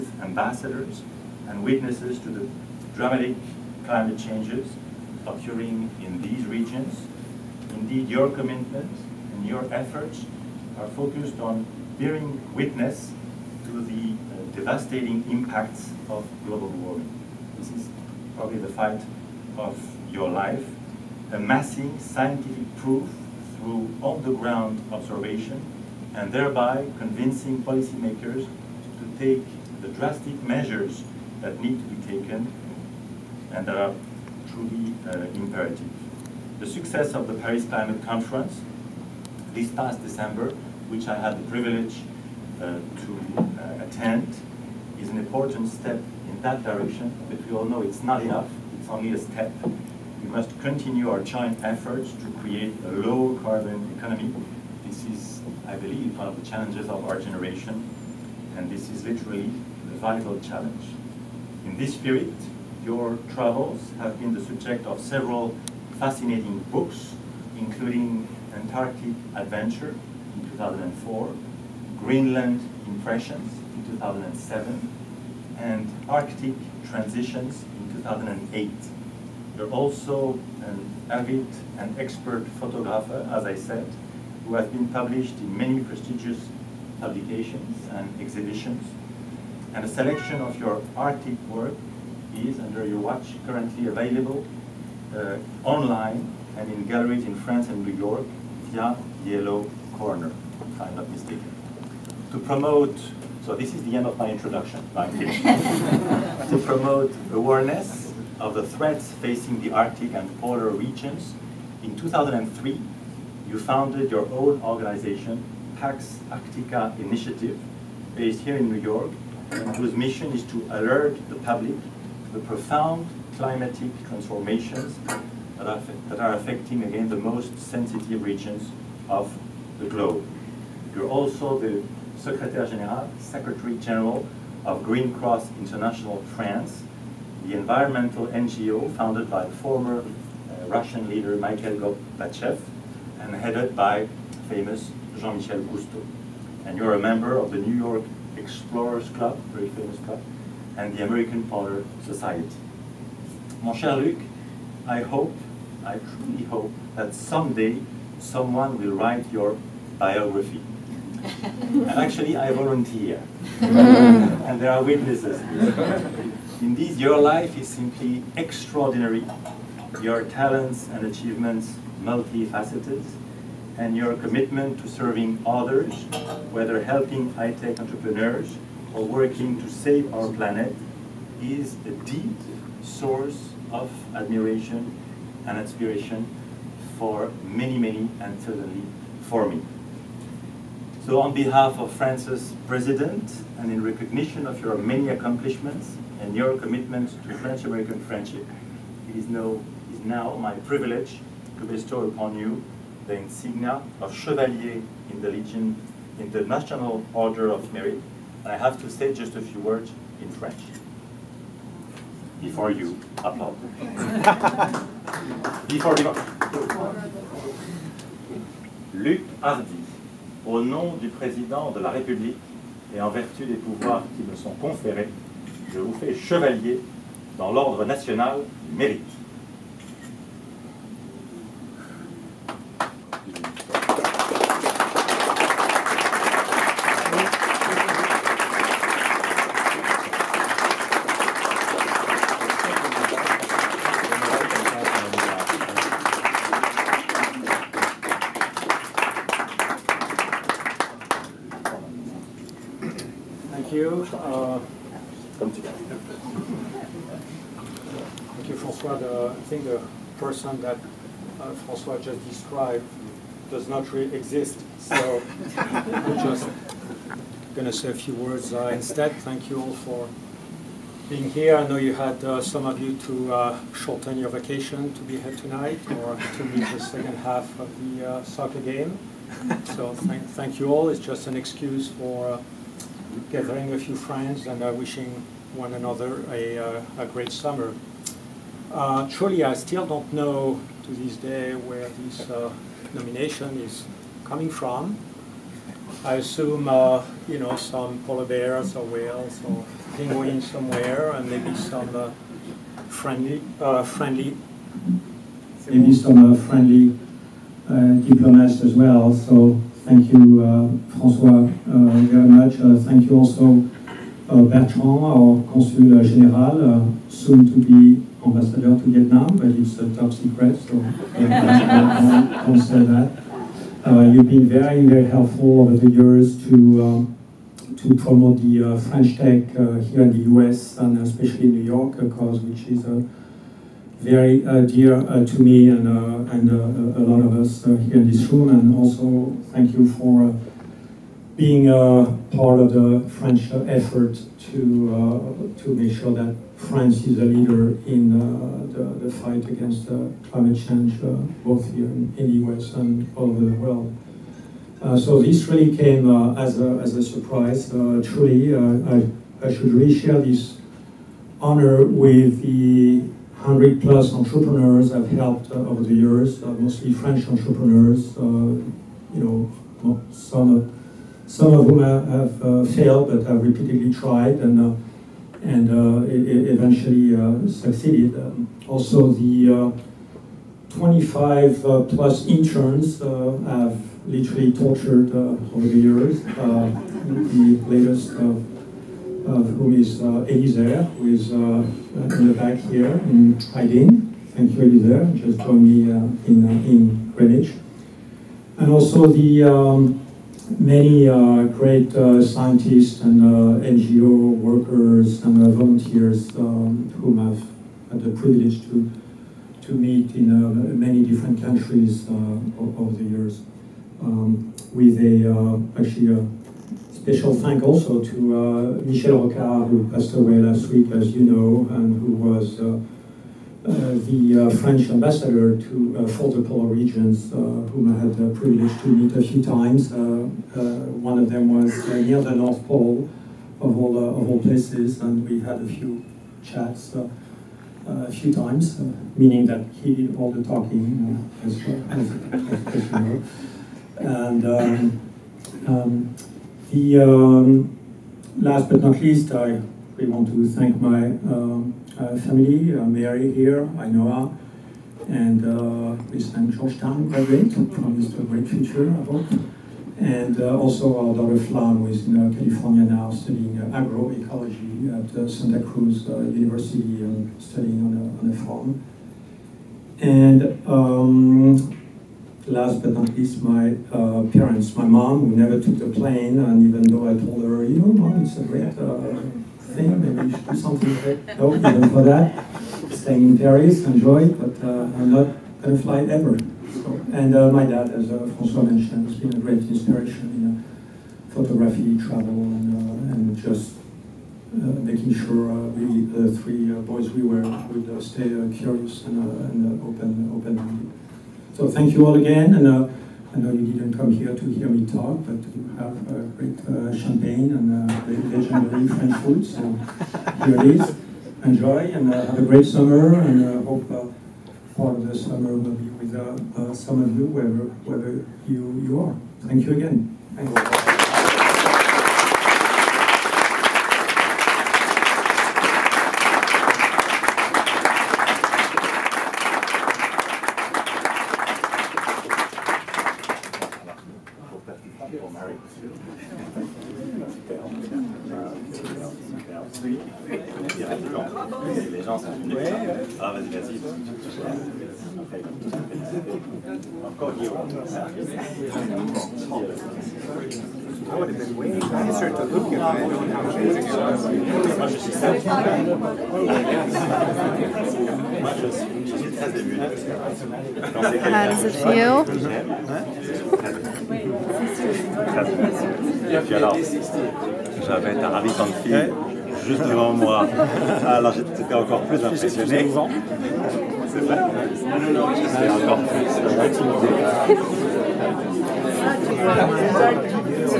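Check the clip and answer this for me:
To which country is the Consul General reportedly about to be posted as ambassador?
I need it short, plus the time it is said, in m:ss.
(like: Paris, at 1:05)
Vietnam, at 5:18.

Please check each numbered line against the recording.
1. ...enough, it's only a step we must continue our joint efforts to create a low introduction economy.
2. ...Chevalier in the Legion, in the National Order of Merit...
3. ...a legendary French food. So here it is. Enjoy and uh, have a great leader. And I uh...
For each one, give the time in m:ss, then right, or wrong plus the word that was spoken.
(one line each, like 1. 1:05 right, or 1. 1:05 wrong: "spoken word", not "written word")
1. 0:48 wrong: "carbon", not "introduction"
2. 3:24 right
3. 8:28 wrong: "summer", not "leader".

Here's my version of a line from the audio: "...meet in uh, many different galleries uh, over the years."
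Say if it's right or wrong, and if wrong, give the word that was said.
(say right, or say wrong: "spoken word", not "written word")
wrong: "countries", not "galleries".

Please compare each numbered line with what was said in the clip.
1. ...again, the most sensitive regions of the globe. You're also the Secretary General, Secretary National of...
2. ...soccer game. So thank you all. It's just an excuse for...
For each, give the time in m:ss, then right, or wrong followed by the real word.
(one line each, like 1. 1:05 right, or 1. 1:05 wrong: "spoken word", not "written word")
1. 2:06 wrong: "General", not "National"
2. 4:38 right.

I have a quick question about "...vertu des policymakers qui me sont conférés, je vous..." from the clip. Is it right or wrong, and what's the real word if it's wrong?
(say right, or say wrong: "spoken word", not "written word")
wrong: "pouvoirs", not "policymakers".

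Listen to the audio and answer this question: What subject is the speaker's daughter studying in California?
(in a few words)
agroecology.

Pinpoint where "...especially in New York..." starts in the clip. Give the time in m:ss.
5:30.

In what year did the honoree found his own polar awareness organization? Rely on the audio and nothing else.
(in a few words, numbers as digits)
2003.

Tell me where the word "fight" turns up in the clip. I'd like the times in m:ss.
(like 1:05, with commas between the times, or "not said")
0:18, 5:49.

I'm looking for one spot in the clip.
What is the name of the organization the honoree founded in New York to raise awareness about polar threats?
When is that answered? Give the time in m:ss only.
1:55.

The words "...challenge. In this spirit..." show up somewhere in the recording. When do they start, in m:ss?
1:00.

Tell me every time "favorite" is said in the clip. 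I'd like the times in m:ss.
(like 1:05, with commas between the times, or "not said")
not said.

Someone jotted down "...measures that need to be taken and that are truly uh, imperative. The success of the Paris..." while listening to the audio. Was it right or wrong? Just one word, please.
right.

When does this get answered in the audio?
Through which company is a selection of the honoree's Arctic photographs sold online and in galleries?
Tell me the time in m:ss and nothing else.
1:39.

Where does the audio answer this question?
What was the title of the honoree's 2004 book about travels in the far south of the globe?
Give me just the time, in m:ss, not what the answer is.
1:08.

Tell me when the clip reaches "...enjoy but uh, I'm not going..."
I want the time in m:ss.
8:03.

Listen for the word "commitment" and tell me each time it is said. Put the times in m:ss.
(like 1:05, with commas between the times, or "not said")
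0:08, 2:54, 3:16.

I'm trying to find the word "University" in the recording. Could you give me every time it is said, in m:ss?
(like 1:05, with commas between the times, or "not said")
7:46.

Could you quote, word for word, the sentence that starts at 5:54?
Uh, so this really came uh, as, a, as a surprise.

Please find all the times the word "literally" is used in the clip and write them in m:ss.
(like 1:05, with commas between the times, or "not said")
0:59, 6:24.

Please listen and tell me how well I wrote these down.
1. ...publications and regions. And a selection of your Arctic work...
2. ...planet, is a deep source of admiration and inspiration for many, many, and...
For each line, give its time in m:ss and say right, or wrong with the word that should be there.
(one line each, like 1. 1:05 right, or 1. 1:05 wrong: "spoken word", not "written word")
1. 1:27 wrong: "exhibitions", not "regions"
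2. 3:00 right.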